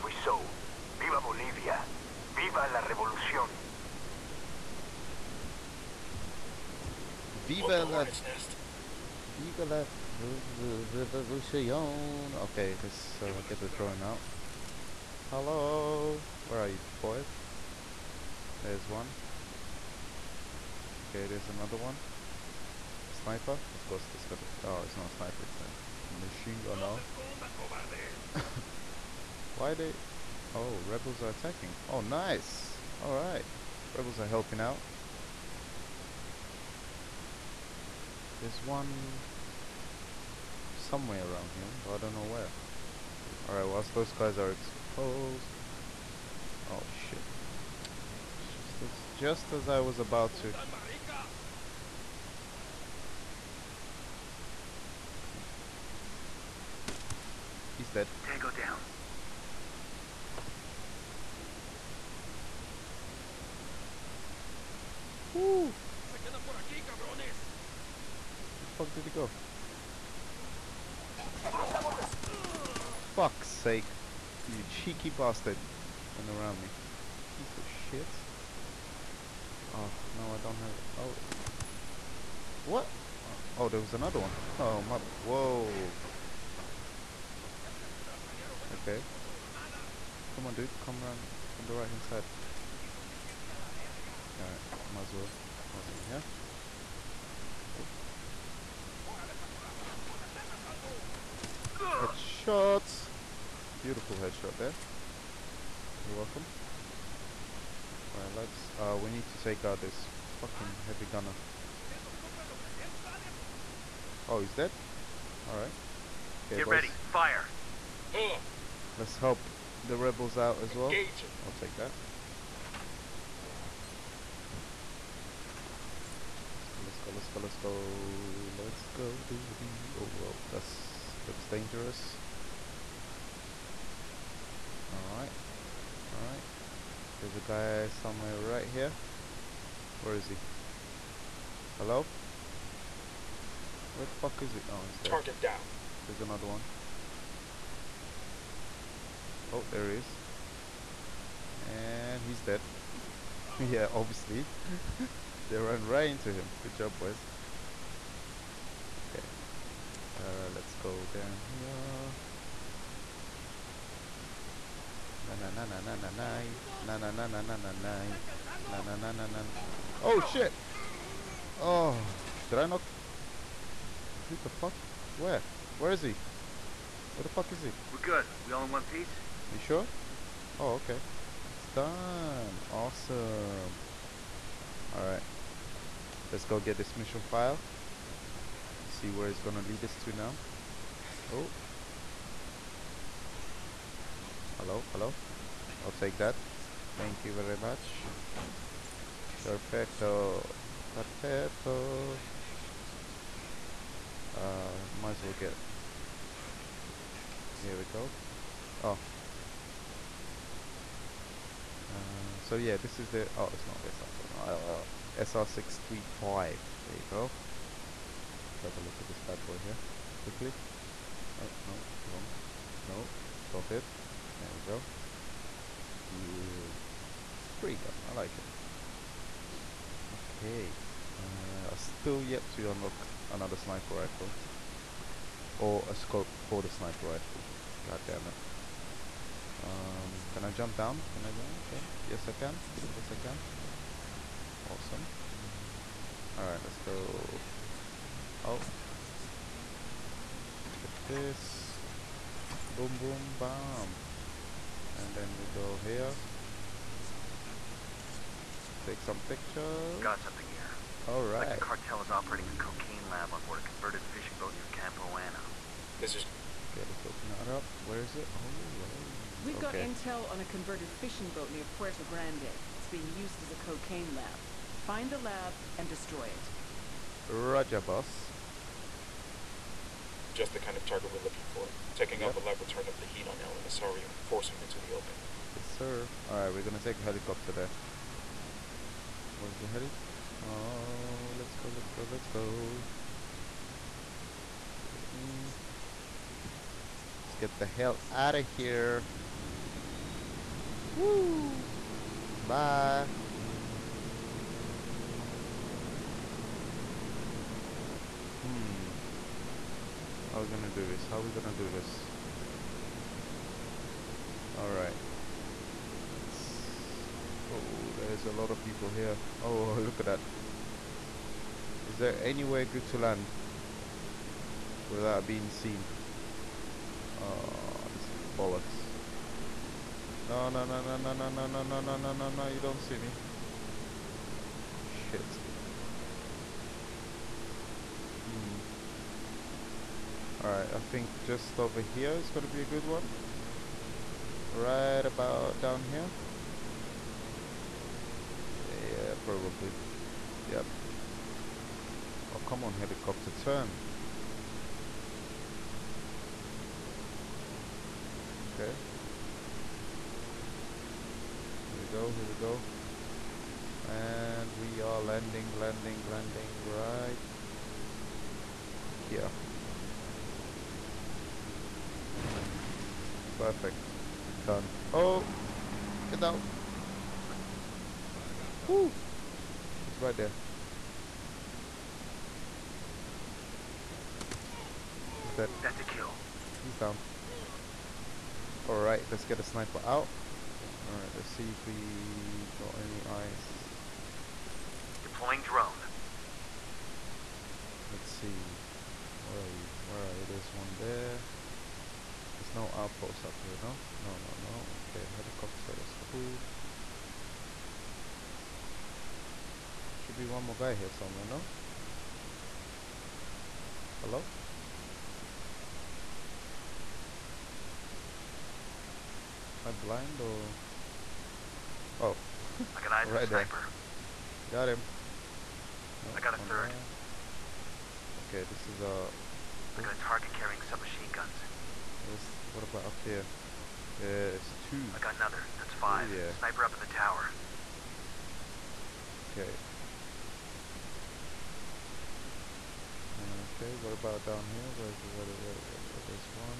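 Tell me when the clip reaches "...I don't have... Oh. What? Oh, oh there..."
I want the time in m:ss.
1:20.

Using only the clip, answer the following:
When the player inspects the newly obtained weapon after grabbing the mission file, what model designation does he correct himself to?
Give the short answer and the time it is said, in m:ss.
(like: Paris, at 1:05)
SR-635, at 3:35.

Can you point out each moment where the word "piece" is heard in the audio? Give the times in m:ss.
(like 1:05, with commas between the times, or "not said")
1:17, 2:58.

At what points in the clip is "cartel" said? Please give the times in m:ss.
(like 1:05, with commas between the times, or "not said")
4:21.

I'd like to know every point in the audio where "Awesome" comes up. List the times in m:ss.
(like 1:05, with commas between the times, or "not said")
1:35, 3:02, 4:04.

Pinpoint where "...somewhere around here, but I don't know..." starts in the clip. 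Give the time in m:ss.
0:40.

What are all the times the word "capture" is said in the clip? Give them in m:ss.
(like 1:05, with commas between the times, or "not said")
not said.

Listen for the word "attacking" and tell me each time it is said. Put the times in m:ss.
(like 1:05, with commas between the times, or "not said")
0:31.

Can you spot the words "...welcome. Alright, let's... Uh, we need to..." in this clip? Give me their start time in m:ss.
1:46.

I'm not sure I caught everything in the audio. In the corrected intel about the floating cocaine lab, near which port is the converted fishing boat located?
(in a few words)
Puerto Grande.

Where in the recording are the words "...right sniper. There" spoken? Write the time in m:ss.
7:03.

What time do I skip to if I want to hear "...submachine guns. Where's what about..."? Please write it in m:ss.
7:10.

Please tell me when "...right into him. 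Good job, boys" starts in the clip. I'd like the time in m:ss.
2:35.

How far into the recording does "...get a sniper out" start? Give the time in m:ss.
6:29.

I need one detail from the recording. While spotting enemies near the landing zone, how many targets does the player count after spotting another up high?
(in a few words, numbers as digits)
5.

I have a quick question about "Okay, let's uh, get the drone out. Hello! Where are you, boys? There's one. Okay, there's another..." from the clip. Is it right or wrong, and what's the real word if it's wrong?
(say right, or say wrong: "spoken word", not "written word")
right.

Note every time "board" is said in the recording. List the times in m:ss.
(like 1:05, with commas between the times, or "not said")
4:23.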